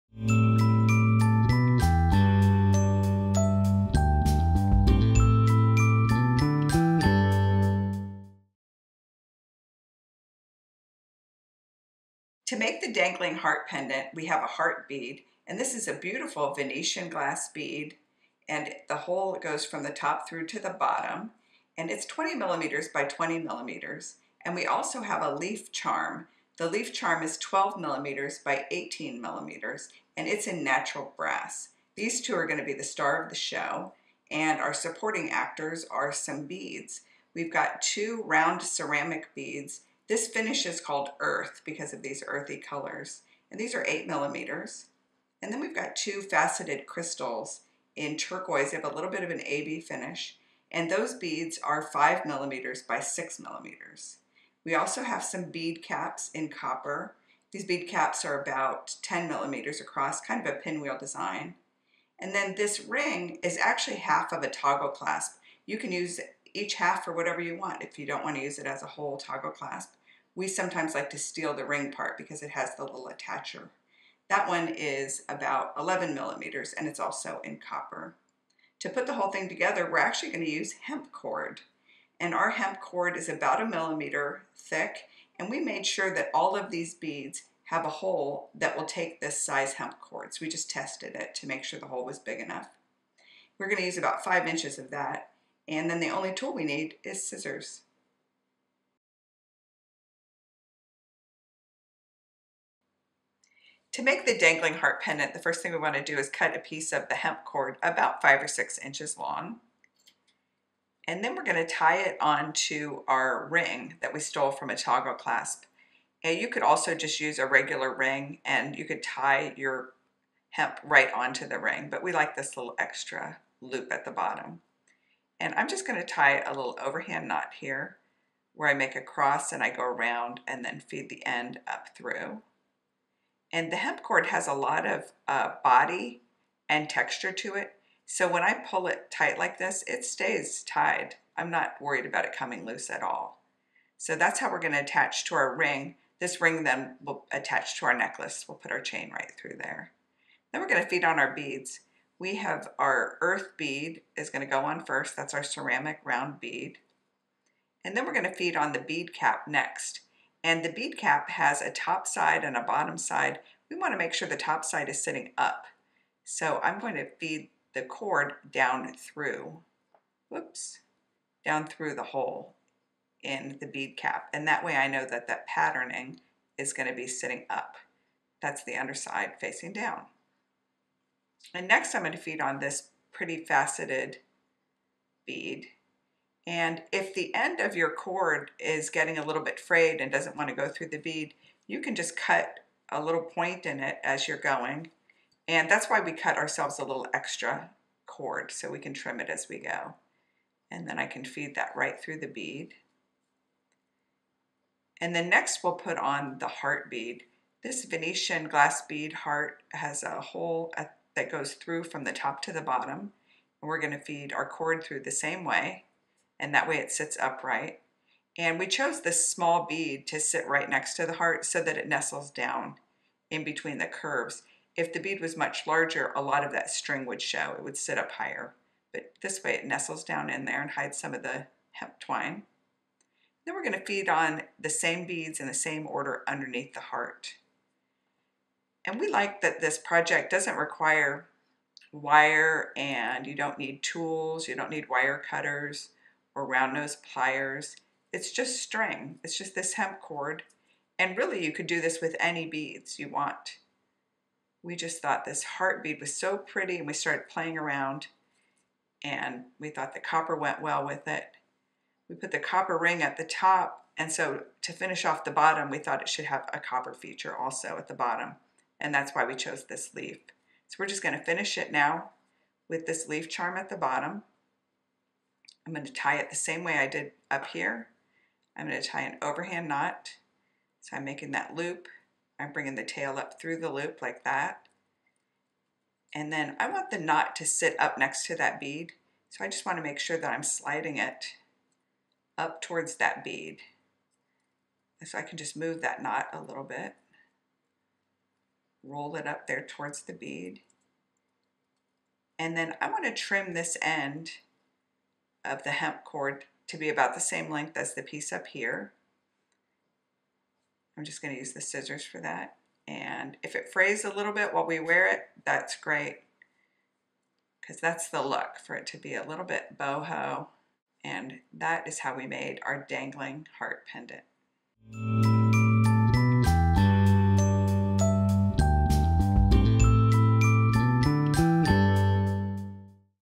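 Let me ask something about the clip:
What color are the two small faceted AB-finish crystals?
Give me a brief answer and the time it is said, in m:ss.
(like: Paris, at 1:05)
Turquoise, at 0:48.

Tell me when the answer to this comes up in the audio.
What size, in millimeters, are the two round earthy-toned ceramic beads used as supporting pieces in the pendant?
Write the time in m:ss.
0:43.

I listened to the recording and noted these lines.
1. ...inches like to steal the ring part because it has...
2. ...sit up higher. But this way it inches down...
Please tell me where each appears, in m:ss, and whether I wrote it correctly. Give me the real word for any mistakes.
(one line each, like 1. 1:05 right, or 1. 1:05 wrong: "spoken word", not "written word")
1. 1:10 wrong: "sometimes", not "inches"
2. 3:47 wrong: "nestles", not "inches".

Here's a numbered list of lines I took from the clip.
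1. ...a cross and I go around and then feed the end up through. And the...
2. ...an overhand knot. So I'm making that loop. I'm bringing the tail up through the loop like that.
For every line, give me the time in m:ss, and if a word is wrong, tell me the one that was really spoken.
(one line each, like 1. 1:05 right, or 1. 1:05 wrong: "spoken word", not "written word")
1. 2:08 right
2. 4:39 right.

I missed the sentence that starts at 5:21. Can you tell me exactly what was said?
And that is how we made our dangling heart pendant.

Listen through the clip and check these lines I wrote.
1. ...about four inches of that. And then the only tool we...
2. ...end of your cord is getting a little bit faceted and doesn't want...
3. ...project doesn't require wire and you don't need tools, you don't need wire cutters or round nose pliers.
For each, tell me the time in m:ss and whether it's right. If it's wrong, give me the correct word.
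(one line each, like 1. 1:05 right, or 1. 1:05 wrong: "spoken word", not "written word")
1. 1:33 wrong: "five", not "four"
2. 3:07 wrong: "frayed", not "faceted"
3. 3:59 right.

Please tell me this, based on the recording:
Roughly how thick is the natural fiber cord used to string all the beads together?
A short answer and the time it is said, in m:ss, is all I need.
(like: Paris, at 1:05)
1 millimeter, at 1:23.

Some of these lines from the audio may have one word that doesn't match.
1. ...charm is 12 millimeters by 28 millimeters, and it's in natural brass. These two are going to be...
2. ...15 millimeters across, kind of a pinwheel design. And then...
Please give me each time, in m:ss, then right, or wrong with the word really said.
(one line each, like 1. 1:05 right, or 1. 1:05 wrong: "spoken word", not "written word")
1. 0:26 wrong: "18", not "28"
2. 0:59 wrong: "10", not "15".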